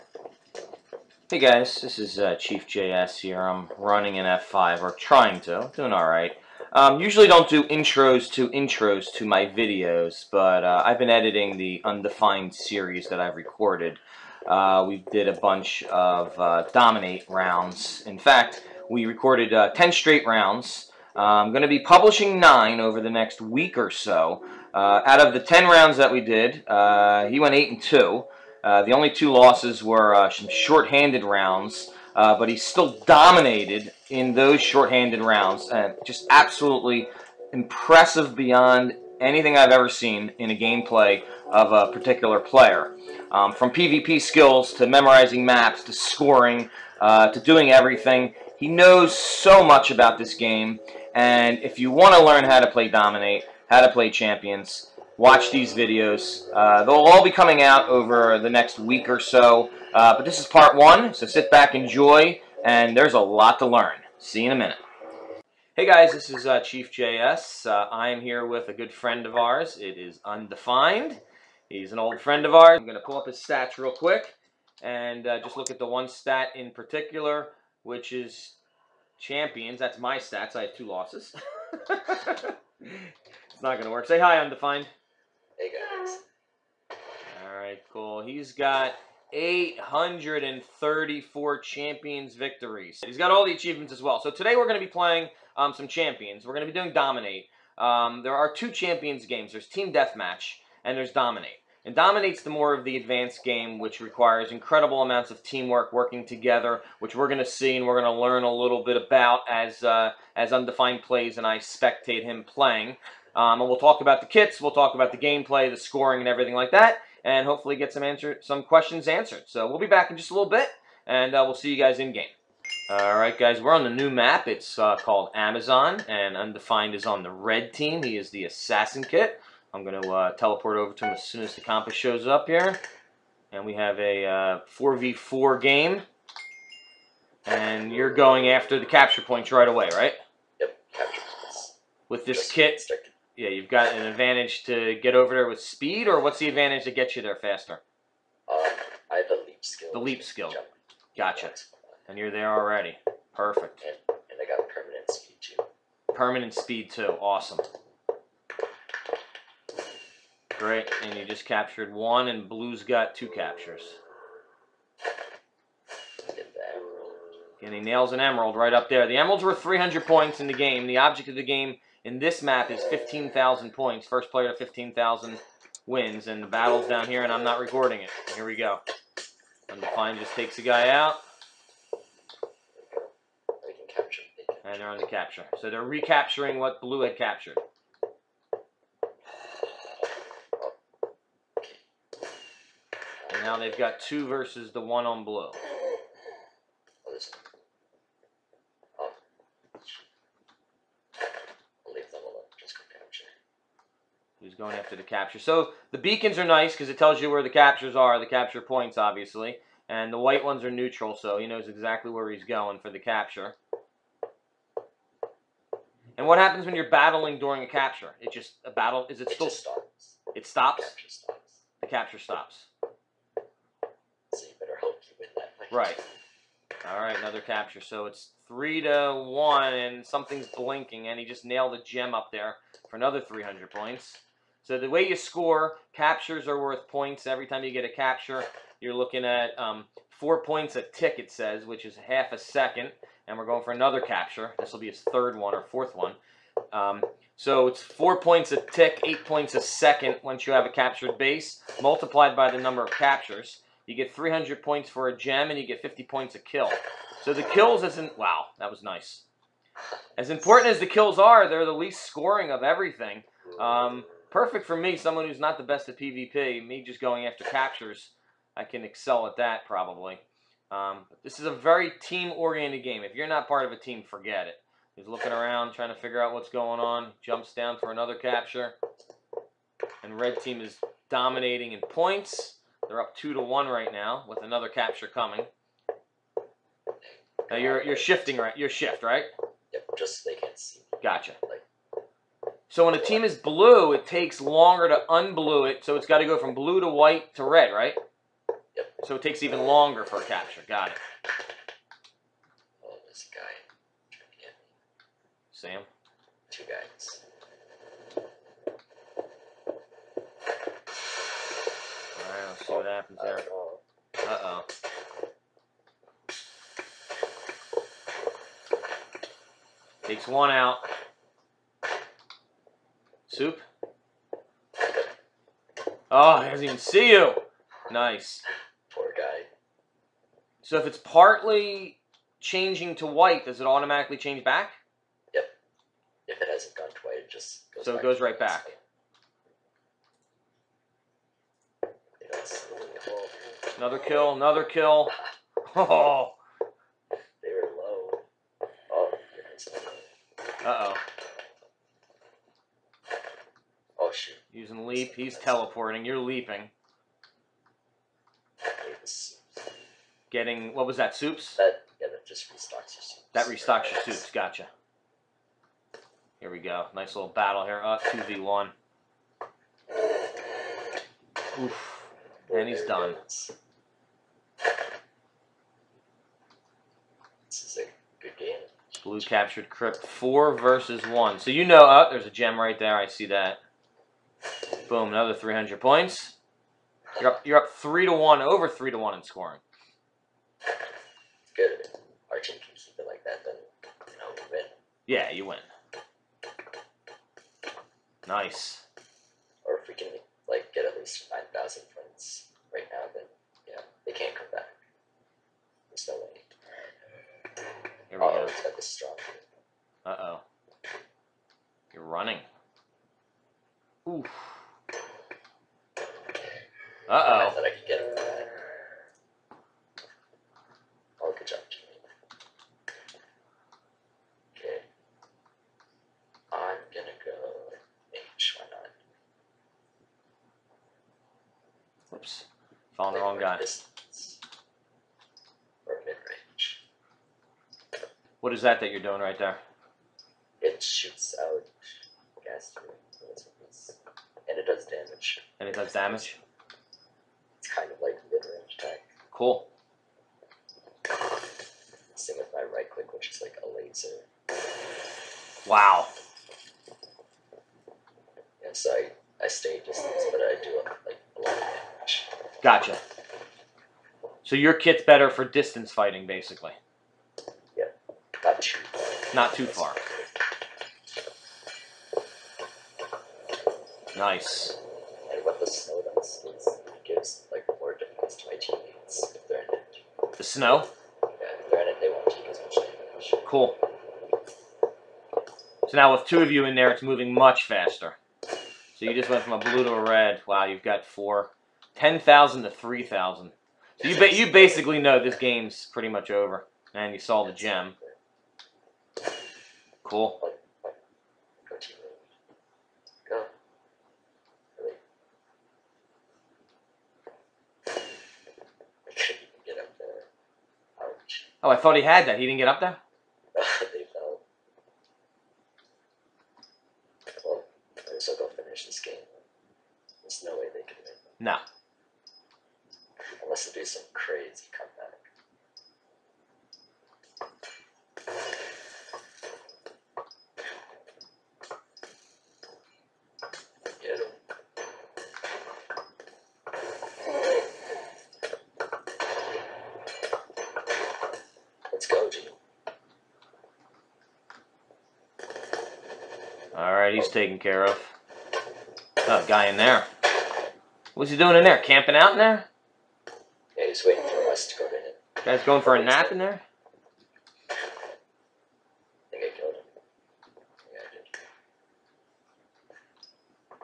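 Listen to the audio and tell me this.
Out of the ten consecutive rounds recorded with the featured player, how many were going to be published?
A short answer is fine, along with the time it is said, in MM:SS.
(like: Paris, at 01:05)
9, at 00:22.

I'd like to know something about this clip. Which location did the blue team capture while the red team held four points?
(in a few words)
crypt.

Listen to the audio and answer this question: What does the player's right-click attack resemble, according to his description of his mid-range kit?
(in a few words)
a laser.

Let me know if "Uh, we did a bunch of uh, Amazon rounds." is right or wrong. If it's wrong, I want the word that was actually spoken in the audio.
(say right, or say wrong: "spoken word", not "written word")
wrong: "Dominate", not "Amazon".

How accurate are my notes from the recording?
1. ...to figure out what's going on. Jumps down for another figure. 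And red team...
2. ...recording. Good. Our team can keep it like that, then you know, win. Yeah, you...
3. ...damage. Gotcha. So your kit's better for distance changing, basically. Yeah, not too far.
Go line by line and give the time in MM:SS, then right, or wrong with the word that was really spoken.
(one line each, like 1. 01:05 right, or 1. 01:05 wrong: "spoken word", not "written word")
1. 04:35 wrong: "capture", not "figure"
2. 06:29 wrong: "scoring", not "recording"
3. 07:41 wrong: "fighting", not "changing".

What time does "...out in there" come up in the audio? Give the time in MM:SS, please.
09:12.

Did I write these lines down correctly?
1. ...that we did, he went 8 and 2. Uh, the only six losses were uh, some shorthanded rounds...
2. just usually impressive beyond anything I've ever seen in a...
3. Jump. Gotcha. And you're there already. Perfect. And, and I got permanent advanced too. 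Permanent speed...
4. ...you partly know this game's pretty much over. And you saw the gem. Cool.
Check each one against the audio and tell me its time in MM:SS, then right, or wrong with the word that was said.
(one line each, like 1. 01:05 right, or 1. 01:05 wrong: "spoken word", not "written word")
1. 00:25 wrong: "two", not "six"
2. 00:36 wrong: "absolutely", not "usually"
3. 02:30 wrong: "speed", not "advanced"
4. 08:14 wrong: "basically", not "partly".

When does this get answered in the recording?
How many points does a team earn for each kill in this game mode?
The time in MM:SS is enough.
04:15.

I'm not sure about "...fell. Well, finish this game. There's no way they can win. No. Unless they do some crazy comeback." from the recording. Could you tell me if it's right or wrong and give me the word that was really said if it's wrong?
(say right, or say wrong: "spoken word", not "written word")
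right.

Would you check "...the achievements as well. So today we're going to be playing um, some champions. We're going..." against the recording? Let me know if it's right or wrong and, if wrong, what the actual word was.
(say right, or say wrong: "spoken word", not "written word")
right.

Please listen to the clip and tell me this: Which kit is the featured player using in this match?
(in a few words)
assassin.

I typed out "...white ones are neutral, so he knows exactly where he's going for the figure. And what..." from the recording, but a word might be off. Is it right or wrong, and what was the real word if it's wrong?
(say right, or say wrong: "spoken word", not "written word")
wrong: "capture", not "figure".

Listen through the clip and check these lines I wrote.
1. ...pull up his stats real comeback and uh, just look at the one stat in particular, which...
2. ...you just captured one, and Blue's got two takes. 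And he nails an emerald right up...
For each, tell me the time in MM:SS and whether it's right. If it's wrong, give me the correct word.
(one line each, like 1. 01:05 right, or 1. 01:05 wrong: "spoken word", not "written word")
1. 01:13 wrong: "quick", not "comeback"
2. 02:41 wrong: "captures", not "takes".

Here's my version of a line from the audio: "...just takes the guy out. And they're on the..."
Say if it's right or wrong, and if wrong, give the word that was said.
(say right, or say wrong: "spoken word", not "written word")
right.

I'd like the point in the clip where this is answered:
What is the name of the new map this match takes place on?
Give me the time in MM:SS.
02:05.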